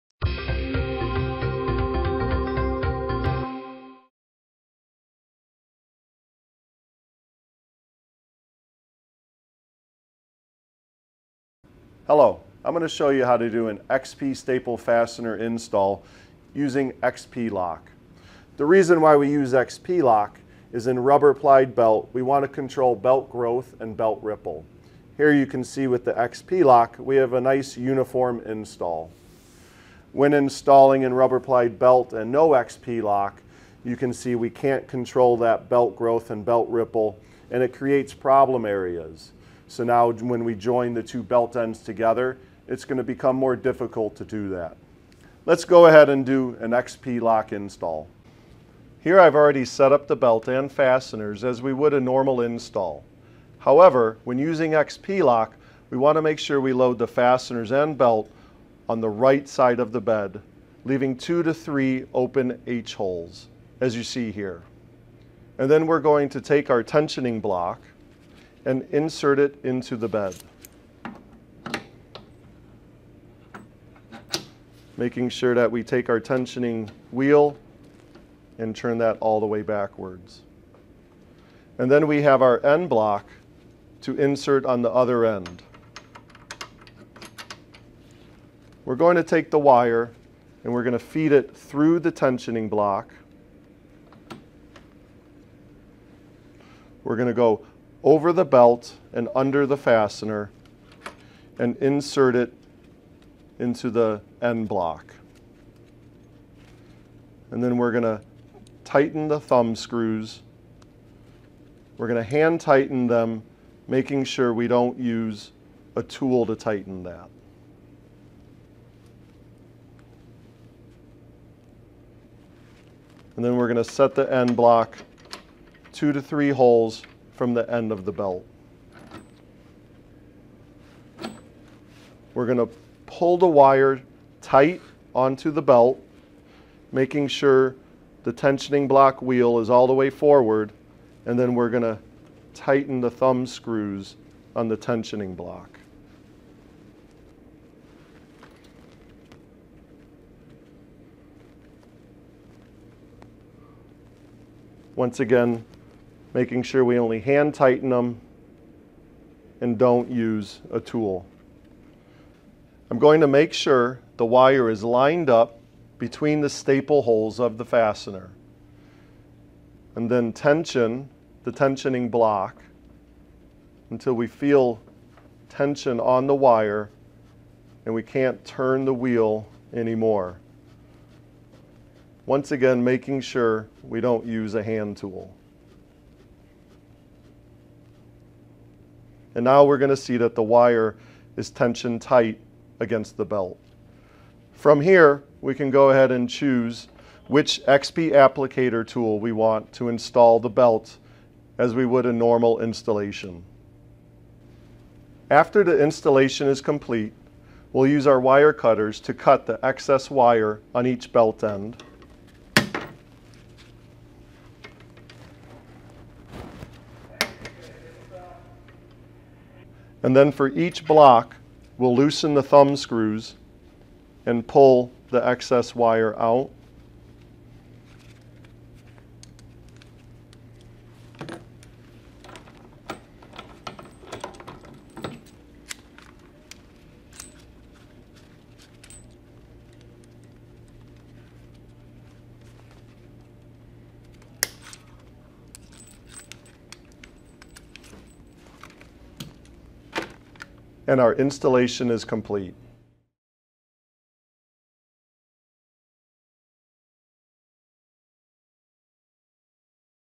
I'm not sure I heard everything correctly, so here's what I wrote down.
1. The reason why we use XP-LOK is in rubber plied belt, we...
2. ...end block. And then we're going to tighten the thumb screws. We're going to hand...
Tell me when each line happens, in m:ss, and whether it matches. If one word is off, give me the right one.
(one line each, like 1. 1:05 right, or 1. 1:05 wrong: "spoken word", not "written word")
1. 0:18 right
2. 1:44 right.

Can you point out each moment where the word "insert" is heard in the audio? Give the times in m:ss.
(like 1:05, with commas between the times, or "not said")
1:08, 1:24, 1:41.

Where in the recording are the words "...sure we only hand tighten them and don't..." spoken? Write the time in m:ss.
2:36.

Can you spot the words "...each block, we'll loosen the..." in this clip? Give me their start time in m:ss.
3:40.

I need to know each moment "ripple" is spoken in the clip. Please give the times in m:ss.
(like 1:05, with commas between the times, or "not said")
0:24, 0:36.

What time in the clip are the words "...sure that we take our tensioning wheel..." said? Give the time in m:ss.
1:15.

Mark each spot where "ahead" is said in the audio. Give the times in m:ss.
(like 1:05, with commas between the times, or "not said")
0:45, 3:15.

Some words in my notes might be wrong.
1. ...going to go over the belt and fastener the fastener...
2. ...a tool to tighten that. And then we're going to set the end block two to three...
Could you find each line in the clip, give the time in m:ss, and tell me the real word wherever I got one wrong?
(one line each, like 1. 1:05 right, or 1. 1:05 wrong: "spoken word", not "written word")
1. 1:37 wrong: "under", not "fastener"
2. 1:55 right.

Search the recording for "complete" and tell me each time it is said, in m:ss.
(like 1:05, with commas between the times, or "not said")
3:26, 4:12.